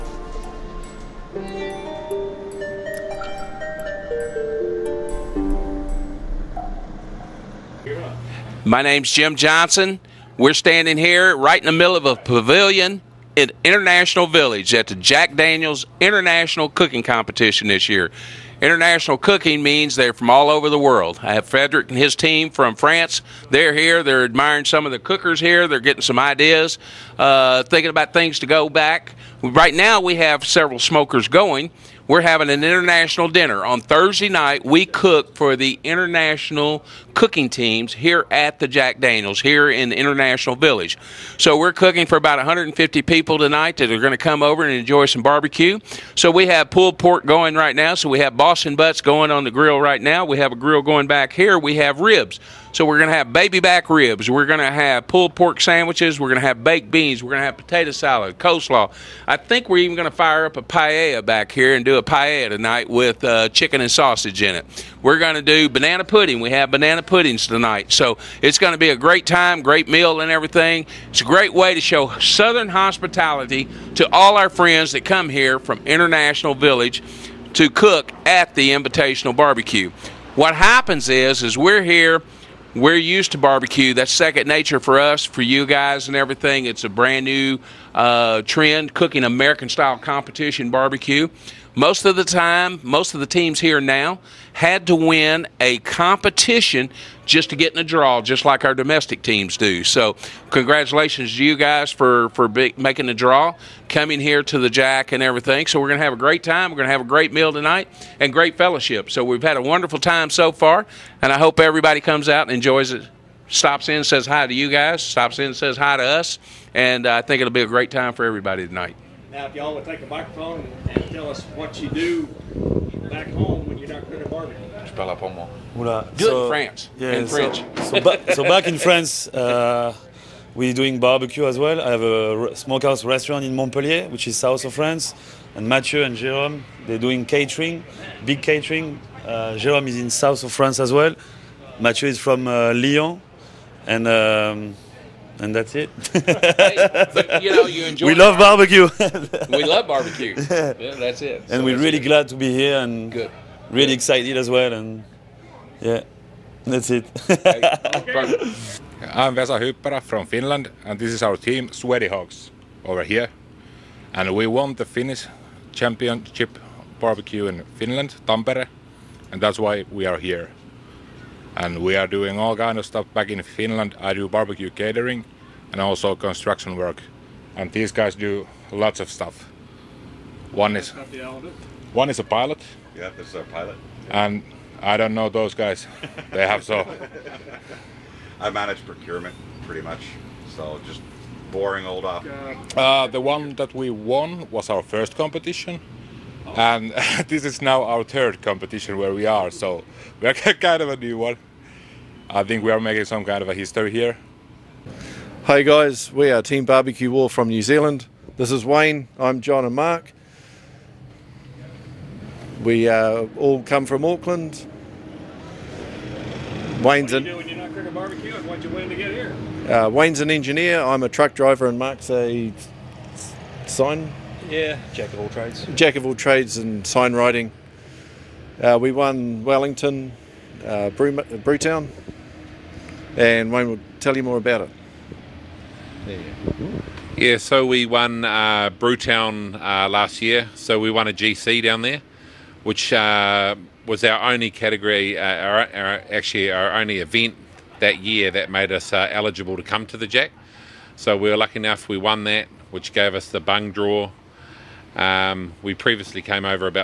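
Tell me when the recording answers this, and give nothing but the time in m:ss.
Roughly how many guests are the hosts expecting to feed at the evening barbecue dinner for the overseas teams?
0:42.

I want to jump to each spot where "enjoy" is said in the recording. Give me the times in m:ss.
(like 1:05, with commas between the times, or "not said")
0:44, 1:52, 2:27.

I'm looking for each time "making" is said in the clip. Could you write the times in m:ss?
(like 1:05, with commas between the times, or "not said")
1:42, 3:22.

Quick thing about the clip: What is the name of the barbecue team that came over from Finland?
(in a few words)
Sweaty Hogs.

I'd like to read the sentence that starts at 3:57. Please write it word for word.
Yeah, so we won uh, Brewtown uh, last year.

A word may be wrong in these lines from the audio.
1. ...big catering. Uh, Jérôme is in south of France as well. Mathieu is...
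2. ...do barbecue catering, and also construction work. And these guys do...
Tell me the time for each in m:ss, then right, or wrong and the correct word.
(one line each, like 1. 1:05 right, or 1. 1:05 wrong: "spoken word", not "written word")
1. 2:18 right
2. 2:54 right.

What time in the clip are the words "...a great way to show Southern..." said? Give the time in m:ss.
1:11.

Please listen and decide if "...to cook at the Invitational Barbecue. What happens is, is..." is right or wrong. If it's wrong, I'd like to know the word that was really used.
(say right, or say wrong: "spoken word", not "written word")
right.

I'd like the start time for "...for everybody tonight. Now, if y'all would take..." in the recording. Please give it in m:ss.
1:58.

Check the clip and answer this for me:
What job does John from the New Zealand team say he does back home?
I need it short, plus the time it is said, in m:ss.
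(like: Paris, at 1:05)
Truck driver, at 3:41.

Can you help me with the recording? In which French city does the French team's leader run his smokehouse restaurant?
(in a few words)
Montpellier.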